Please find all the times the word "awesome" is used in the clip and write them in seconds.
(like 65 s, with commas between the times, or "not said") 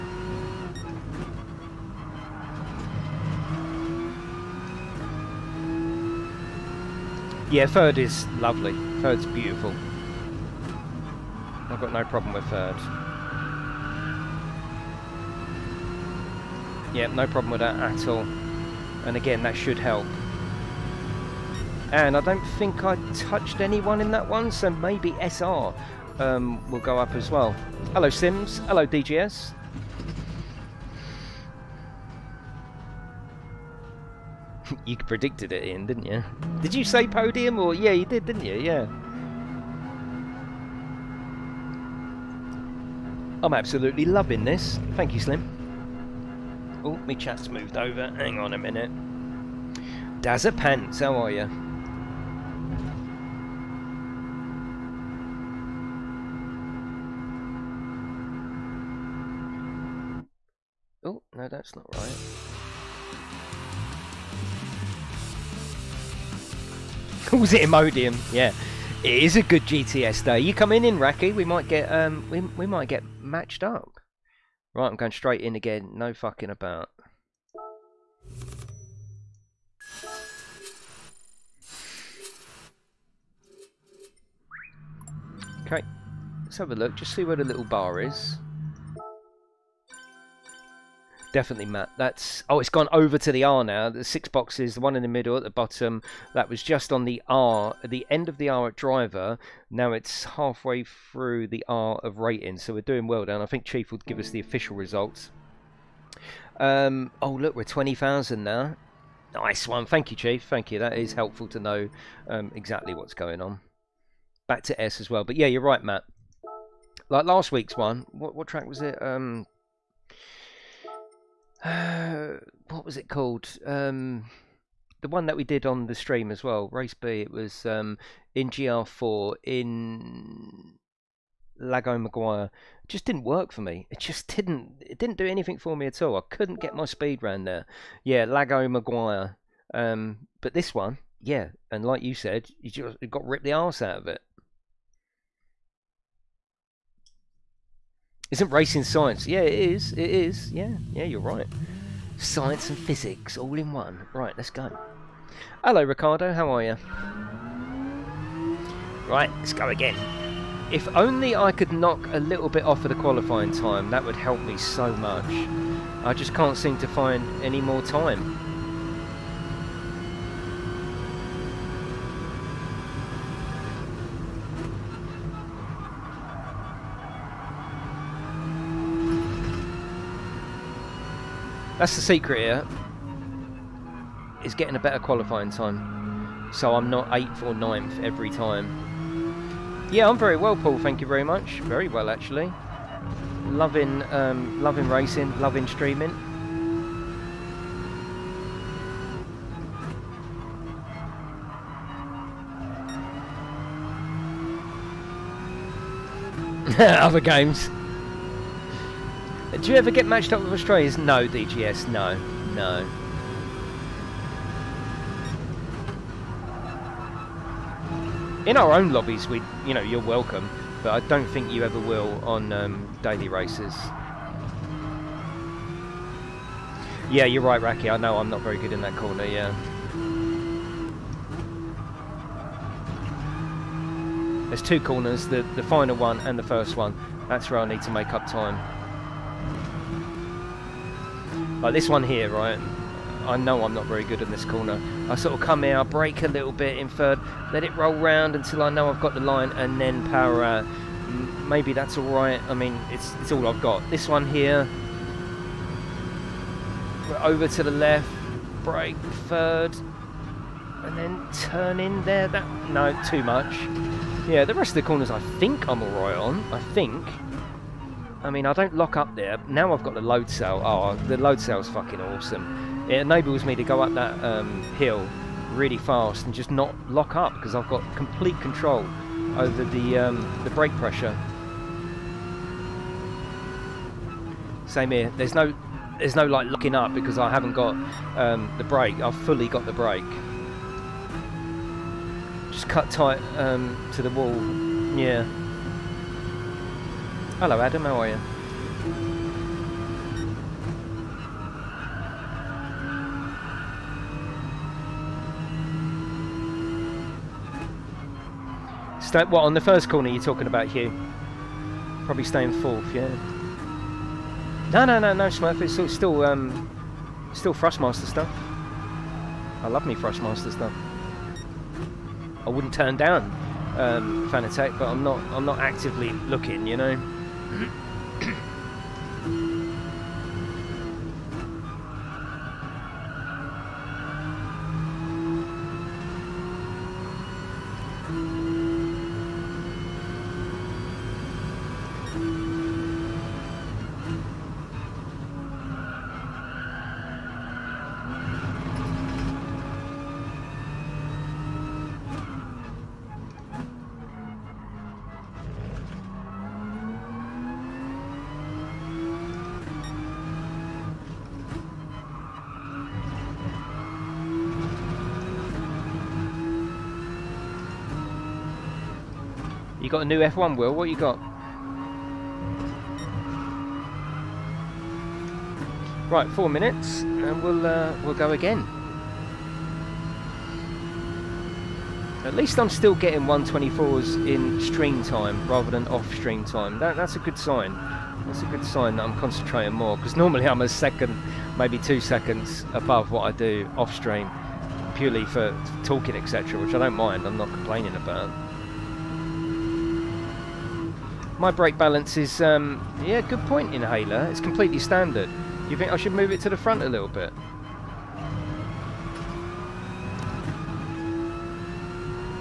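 272 s.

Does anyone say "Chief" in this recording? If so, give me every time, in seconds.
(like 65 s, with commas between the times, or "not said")
103 s, 110 s.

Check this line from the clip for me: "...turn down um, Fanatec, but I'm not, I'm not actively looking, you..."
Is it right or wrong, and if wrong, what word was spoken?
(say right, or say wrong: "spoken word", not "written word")
right.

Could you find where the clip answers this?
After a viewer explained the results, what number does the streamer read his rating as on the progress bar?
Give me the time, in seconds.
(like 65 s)
107 s.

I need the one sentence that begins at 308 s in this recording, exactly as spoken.
Stay, what, on the first corner you're talking about, Hugh?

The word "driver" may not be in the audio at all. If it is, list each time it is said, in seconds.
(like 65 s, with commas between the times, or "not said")
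98 s.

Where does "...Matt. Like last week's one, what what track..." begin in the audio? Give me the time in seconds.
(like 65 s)
115 s.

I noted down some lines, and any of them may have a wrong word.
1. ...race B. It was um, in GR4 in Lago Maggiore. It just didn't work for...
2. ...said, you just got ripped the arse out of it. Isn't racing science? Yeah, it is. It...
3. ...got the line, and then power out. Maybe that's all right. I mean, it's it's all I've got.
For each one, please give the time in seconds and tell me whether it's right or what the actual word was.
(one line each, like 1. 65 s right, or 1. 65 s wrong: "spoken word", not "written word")
1. 126 s right
2. 142 s right
3. 248 s right.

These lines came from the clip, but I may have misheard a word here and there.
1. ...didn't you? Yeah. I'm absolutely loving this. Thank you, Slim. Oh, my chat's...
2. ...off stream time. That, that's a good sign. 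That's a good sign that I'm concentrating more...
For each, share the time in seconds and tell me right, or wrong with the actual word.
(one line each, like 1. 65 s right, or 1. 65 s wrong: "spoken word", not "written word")
1. 38 s right
2. 385 s right.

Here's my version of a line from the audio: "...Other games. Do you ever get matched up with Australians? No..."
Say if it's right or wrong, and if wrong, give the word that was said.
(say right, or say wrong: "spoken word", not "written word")
right.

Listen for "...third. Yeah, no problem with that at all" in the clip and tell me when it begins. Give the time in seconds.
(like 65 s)
12 s.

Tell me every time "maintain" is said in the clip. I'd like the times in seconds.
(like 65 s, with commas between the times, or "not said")
not said.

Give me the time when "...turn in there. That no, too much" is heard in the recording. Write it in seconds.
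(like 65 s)
261 s.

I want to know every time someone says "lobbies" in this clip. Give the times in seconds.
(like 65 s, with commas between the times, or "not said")
218 s.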